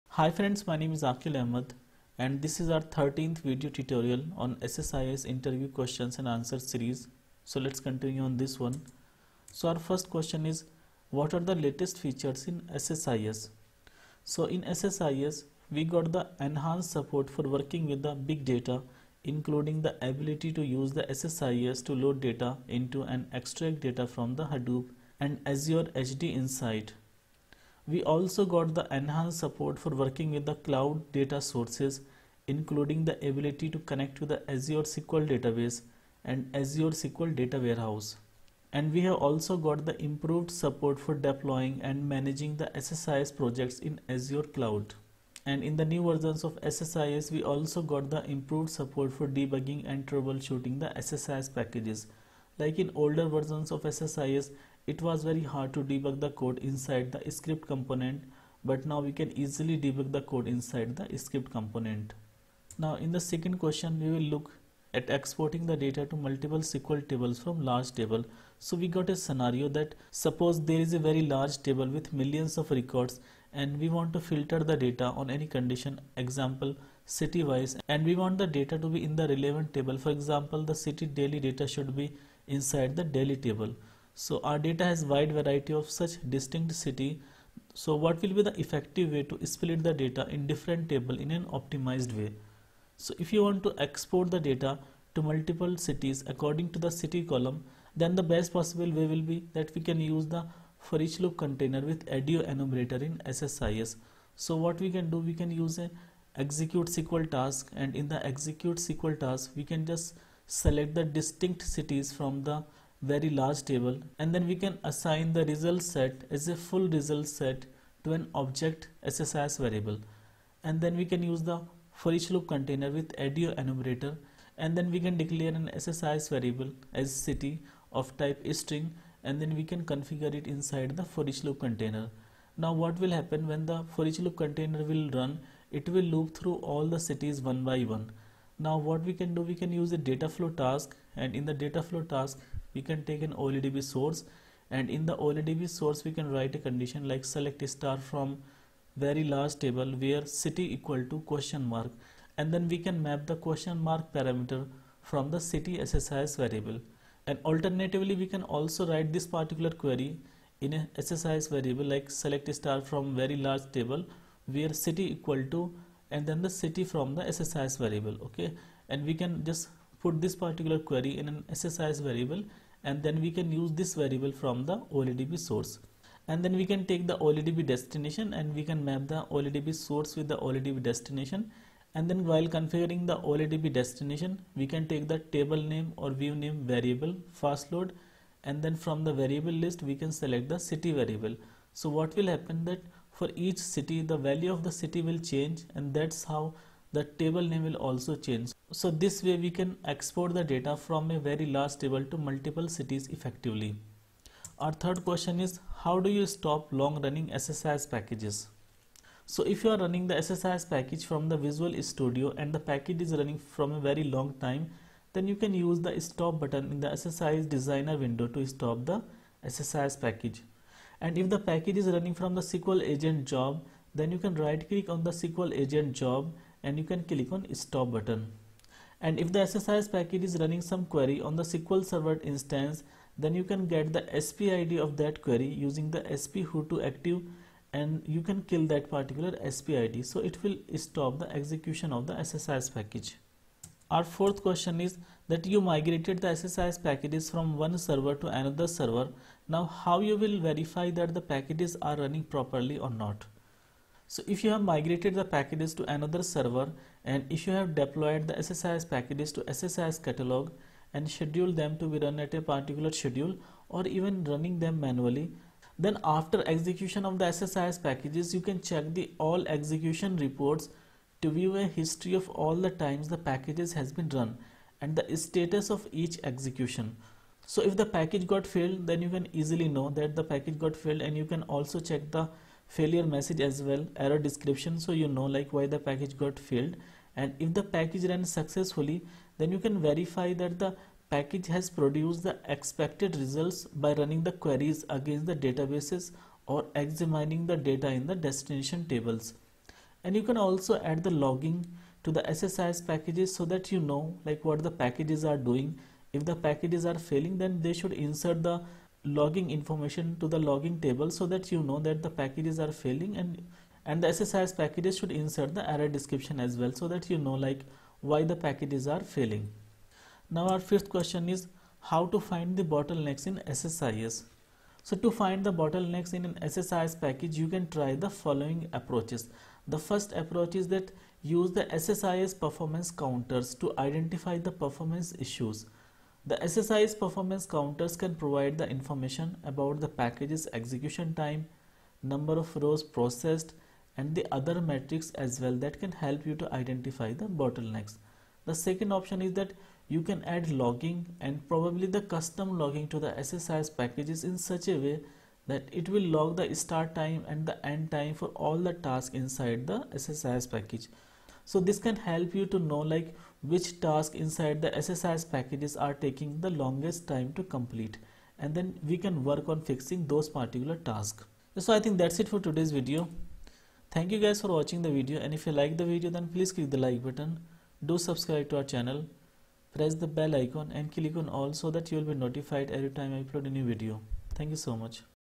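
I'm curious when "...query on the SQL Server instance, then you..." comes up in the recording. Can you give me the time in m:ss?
3:50.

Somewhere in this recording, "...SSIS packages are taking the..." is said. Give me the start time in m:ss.
6:04.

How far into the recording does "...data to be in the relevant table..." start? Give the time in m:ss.
1:18.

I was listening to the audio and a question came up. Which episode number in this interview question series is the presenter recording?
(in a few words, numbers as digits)
13th.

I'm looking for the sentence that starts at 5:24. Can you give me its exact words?
So to find the bottlenecks in an SSIS package you can try the following approaches.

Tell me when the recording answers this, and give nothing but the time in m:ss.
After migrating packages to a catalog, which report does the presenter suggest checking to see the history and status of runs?
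4:29.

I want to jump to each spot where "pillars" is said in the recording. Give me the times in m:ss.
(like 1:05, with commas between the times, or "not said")
not said.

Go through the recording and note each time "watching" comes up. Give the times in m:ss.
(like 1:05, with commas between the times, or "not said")
6:14.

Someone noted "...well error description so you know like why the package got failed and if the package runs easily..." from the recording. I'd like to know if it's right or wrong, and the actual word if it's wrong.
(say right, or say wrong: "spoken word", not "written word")
wrong: "successfully", not "easily".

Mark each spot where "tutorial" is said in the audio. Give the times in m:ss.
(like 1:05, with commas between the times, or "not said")
0:03.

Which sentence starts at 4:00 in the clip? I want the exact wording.
So it will stop the execution of the SSIS package.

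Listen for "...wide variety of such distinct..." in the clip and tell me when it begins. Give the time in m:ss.
1:25.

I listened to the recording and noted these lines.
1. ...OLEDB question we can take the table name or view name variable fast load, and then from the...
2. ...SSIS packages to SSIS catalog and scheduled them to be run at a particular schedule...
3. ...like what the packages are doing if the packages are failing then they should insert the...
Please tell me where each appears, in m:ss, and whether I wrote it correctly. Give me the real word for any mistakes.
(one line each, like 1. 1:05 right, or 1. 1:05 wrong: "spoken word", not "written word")
1. 3:03 wrong: "destination", not "question"
2. 4:18 right
3. 5:04 right.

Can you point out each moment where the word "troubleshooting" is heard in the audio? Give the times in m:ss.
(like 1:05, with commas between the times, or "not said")
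0:50.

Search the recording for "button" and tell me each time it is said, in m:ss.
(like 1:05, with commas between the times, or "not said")
3:36, 3:47, 6:17.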